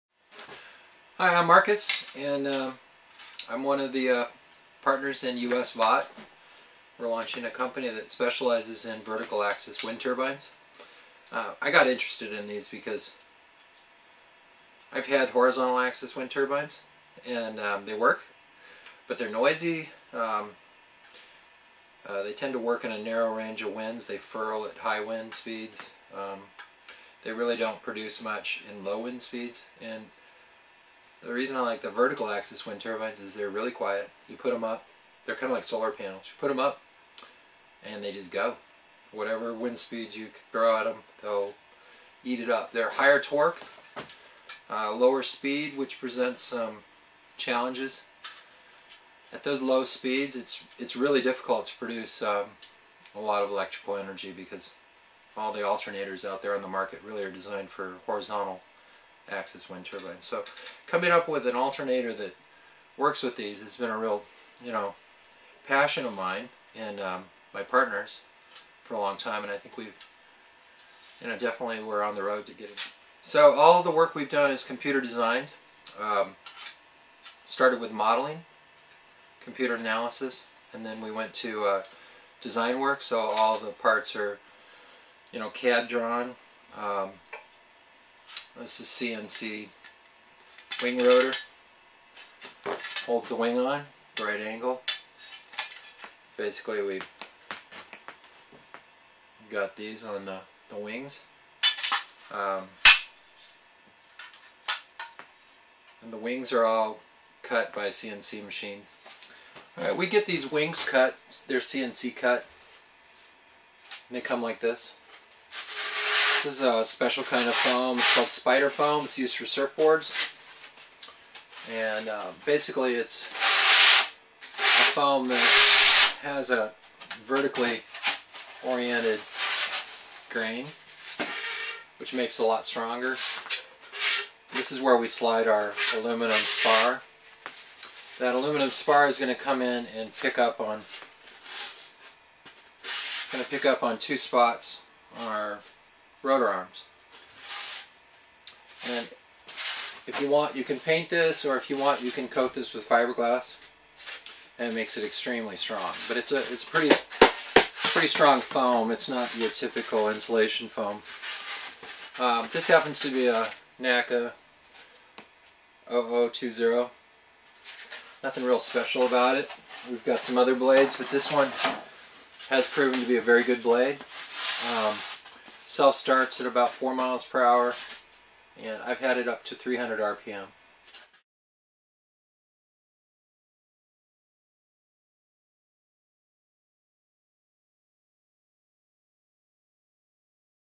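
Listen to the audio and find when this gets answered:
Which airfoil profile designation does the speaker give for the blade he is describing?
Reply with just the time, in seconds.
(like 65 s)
163 s.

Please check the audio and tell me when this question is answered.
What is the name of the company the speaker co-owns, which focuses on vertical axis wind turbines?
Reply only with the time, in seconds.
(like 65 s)
5 s.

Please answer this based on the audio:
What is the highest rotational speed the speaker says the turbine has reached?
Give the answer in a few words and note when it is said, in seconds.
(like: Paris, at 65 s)
300 RPM, at 179 s.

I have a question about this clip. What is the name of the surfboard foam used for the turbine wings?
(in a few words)
spider foam.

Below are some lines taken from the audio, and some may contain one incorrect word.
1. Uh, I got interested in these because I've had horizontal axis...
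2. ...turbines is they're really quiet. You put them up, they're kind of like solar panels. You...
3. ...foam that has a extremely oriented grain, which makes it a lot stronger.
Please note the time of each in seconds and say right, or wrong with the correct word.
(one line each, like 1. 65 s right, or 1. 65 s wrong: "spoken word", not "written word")
1. 11 s right
2. 32 s right
3. 124 s wrong: "vertically", not "extremely".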